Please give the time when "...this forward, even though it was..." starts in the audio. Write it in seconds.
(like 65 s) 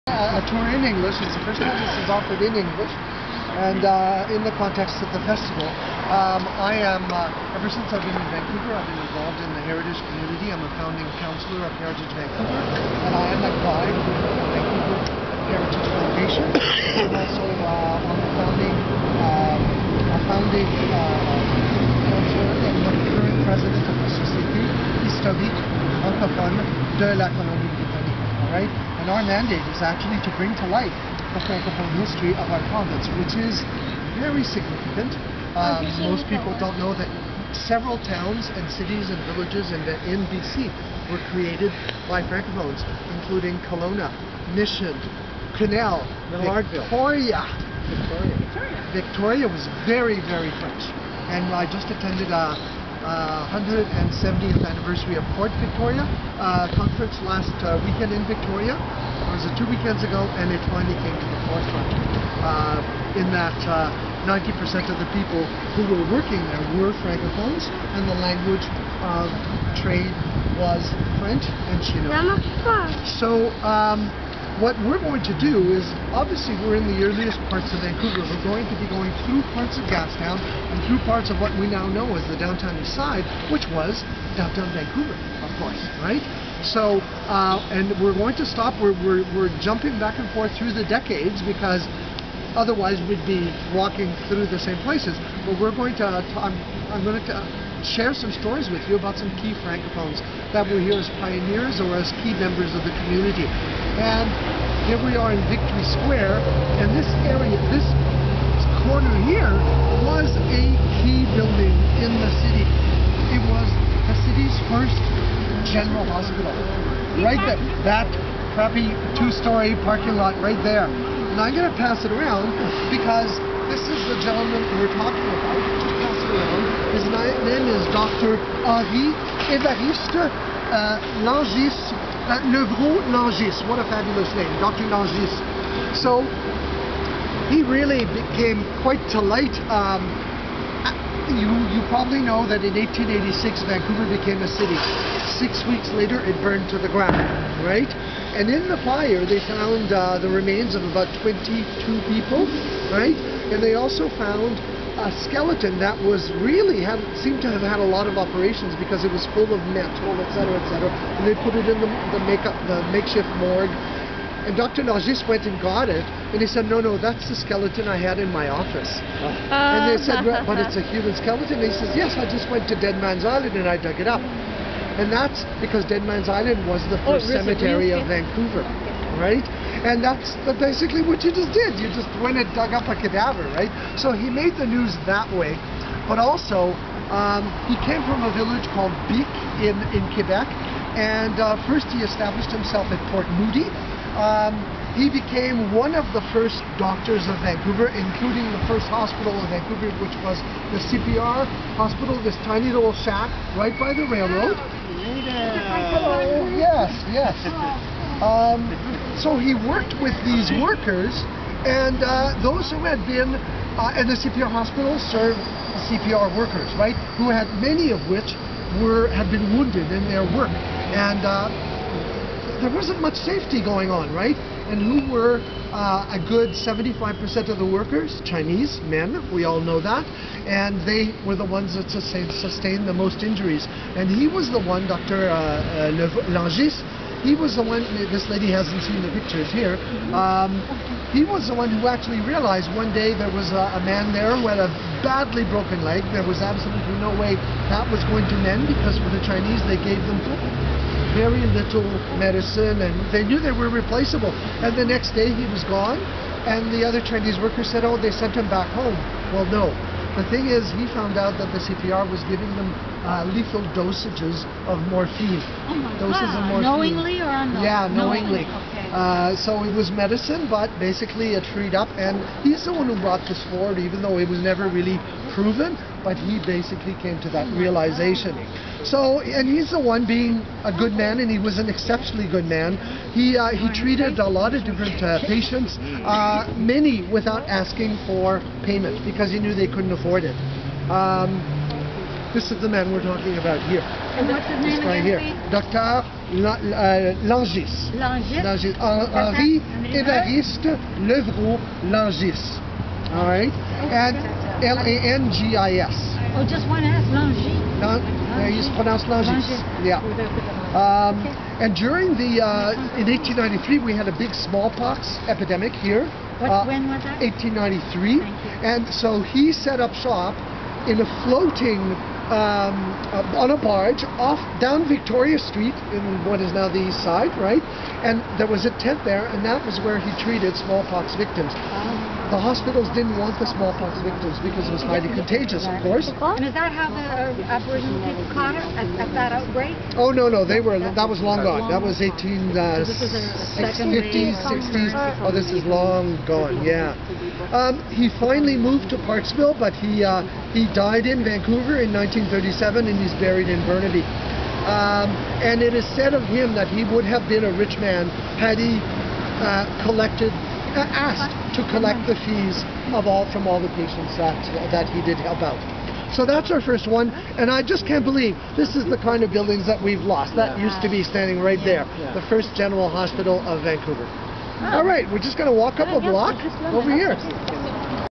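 273 s.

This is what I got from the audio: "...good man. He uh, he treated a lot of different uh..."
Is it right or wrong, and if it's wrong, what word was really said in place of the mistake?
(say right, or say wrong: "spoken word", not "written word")
right.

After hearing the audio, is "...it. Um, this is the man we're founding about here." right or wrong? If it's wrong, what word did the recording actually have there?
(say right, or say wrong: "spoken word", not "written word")
wrong: "talking", not "founding".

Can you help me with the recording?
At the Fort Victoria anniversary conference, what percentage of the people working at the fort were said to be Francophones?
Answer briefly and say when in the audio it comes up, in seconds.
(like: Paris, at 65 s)
90%, at 64 s.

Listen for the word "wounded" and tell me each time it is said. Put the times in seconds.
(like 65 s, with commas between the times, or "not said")
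219 s.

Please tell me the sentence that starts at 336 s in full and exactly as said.
And is that how the uh, Aboriginal people caught it at, at, that outbreak?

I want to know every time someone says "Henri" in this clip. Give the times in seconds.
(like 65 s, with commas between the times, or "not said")
128 s, 298 s.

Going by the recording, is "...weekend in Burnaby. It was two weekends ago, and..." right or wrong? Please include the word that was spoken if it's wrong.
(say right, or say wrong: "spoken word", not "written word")
wrong: "Victoria", not "Burnaby".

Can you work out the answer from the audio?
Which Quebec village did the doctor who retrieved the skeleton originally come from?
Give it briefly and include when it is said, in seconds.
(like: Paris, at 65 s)
Bic, at 189 s.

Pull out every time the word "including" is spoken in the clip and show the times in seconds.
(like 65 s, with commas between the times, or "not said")
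43 s, 197 s.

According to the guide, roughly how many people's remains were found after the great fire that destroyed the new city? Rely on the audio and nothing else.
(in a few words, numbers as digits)
22.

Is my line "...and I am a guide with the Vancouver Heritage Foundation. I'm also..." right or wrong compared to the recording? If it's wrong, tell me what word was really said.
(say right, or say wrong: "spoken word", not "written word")
right.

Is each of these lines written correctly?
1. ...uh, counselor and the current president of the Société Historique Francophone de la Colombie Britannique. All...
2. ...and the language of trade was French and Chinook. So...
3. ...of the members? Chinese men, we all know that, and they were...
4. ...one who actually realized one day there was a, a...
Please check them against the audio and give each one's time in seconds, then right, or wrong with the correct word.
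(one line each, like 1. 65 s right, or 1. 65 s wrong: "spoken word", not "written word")
1. 20 s right
2. 67 s right
3. 227 s wrong: "workers", not "members"
4. 241 s right.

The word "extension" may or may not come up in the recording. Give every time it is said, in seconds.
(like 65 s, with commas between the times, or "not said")
not said.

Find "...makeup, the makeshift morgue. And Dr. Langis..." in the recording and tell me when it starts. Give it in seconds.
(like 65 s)
162 s.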